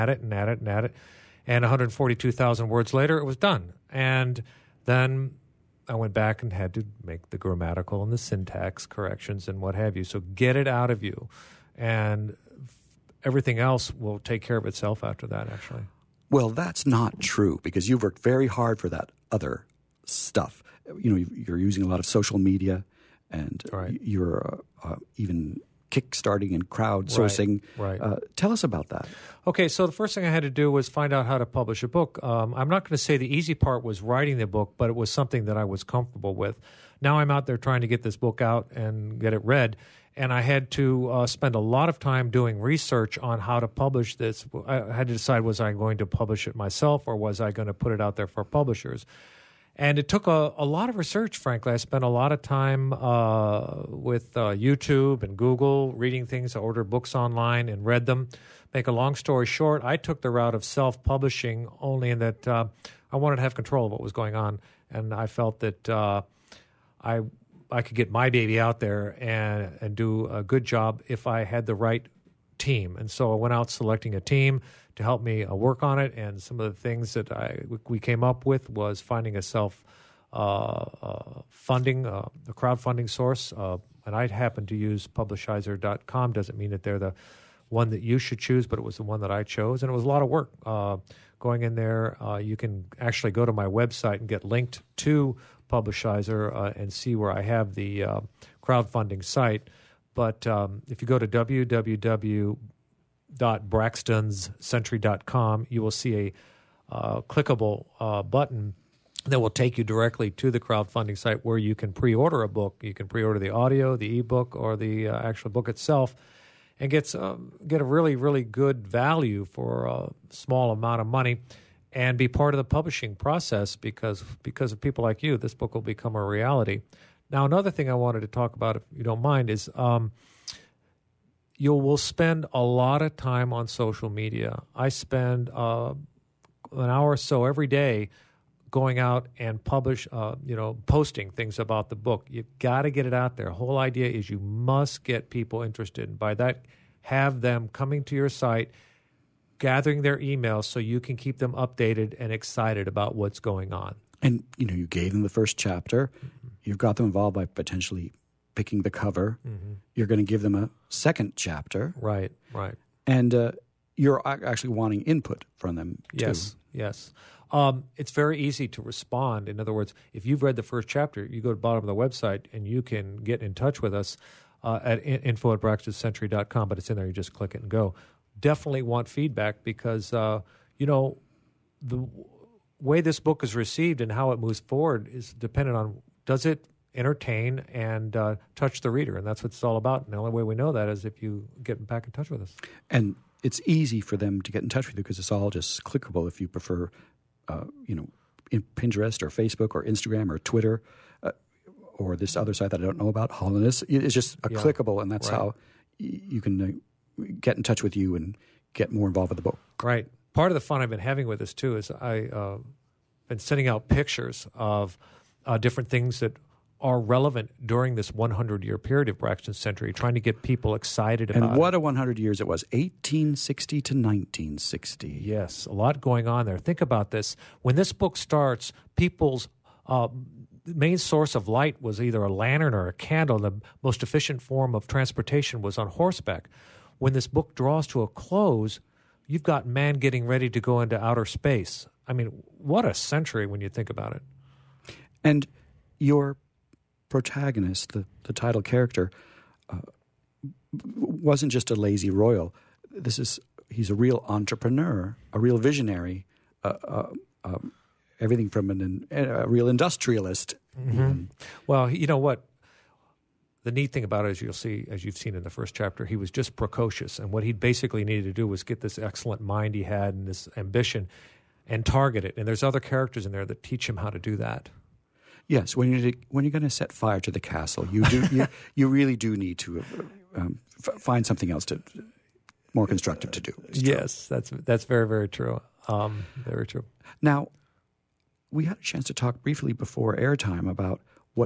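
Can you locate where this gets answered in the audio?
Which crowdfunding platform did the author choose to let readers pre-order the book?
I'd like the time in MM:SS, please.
01:25.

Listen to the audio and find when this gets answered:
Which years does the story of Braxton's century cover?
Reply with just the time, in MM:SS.
03:42.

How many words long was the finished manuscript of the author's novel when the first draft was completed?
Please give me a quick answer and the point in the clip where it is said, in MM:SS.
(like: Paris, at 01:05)
142,000, at 00:01.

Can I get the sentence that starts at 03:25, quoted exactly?
how you can uh, get in touch with you and get more involved with the book.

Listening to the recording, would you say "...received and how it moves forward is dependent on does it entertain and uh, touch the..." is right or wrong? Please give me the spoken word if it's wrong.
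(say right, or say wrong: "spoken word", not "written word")
right.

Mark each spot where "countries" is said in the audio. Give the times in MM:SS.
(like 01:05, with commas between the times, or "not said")
not said.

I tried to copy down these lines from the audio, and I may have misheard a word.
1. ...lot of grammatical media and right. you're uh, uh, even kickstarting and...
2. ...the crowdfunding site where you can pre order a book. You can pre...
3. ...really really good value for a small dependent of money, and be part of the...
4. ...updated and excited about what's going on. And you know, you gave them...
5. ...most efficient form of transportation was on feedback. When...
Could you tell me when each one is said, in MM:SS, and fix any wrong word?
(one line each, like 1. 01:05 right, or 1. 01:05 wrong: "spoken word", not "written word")
1. 00:21 wrong: "social", not "grammatical"
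2. 01:50 right
3. 01:57 wrong: "amount", not "dependent"
4. 02:31 right
5. 03:53 wrong: "horseback", not "feedback".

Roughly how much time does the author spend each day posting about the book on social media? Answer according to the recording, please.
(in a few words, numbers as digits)
An hour.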